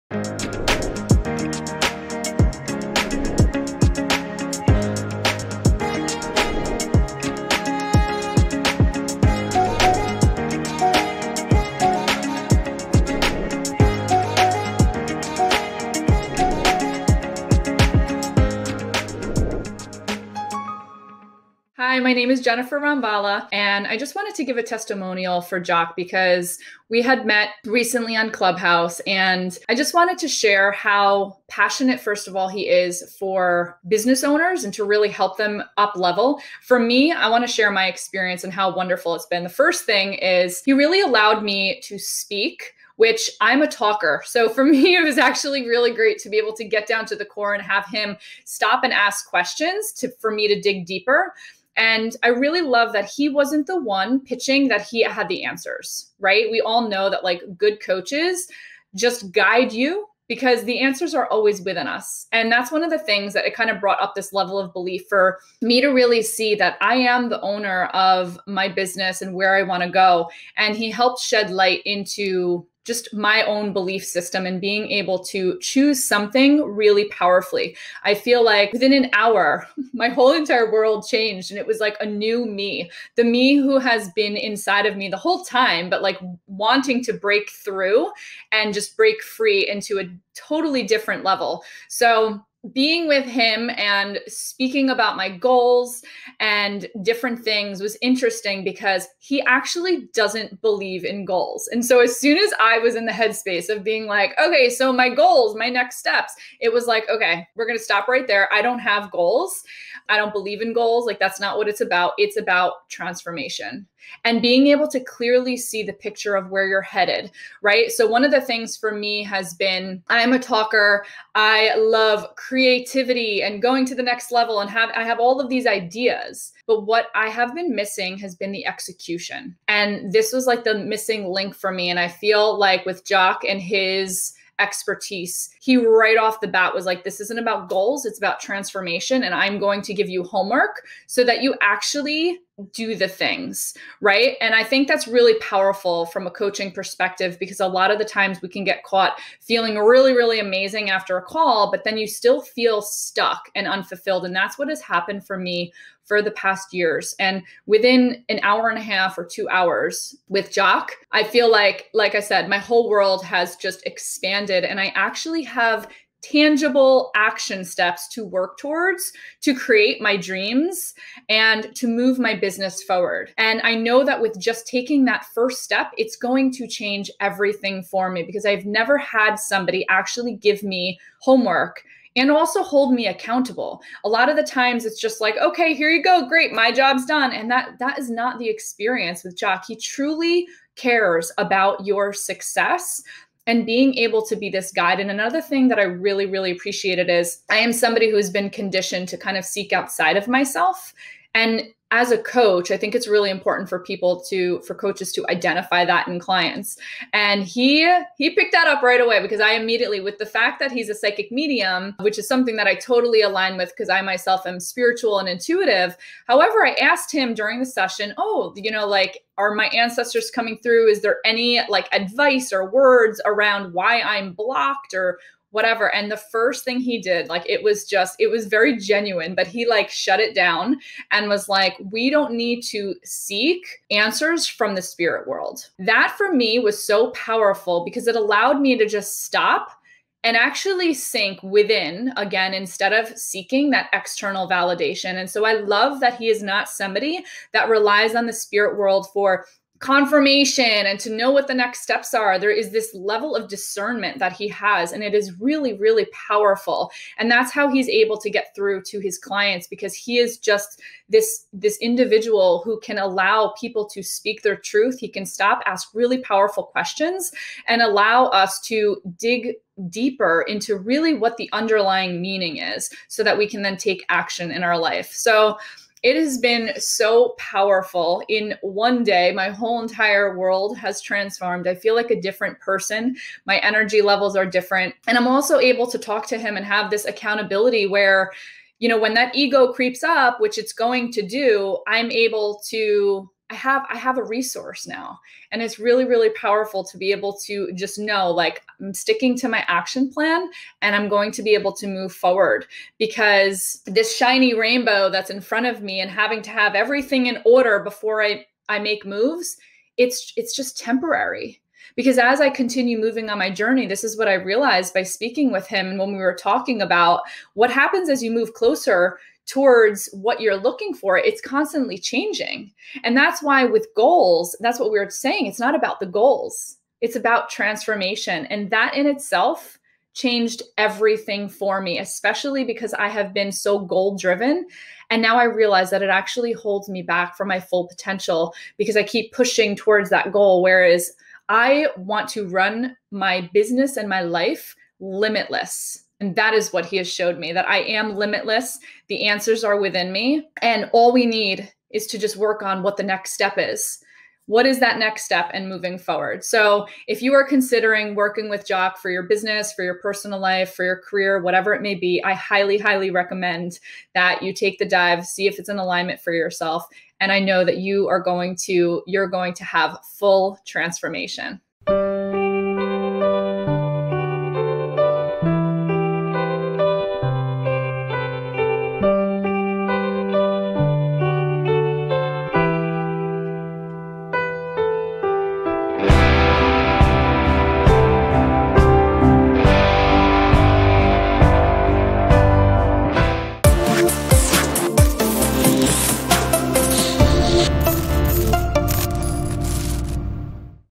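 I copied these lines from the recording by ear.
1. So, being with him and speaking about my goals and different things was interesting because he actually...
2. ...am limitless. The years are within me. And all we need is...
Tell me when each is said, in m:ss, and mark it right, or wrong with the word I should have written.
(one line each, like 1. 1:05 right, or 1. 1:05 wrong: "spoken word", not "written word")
1. 1:31 right
2. 5:47 wrong: "answers", not "years".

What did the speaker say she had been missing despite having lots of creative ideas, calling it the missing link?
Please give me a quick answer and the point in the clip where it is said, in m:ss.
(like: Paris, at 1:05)
execution, at 2:08.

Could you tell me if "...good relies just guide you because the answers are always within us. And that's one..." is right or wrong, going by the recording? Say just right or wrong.
wrong.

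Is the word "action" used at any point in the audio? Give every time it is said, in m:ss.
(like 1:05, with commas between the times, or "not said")
2:47, 4:34, 4:59.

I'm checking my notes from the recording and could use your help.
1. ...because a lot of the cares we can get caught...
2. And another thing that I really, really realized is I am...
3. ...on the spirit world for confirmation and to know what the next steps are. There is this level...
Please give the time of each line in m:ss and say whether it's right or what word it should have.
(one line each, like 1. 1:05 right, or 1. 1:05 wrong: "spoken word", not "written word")
1. 2:27 wrong: "times", not "cares"
2. 3:14 wrong: "appreciated", not "realized"
3. 4:08 right.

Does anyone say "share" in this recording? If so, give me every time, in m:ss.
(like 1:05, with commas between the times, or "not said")
0:30, 0:37.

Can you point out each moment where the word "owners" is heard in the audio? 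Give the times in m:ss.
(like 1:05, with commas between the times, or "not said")
0:34, 1:07.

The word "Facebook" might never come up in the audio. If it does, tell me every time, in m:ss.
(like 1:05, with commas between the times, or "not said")
not said.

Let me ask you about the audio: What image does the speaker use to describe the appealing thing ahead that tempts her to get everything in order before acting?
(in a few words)
shiny rainbow.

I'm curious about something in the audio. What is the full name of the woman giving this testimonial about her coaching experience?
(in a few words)
Jennifer Rambala.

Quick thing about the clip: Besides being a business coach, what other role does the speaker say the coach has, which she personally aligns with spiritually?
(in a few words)
psychic medium.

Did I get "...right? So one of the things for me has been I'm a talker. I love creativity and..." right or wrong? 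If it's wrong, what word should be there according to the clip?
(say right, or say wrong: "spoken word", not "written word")
right.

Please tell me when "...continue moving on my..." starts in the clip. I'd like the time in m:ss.
5:12.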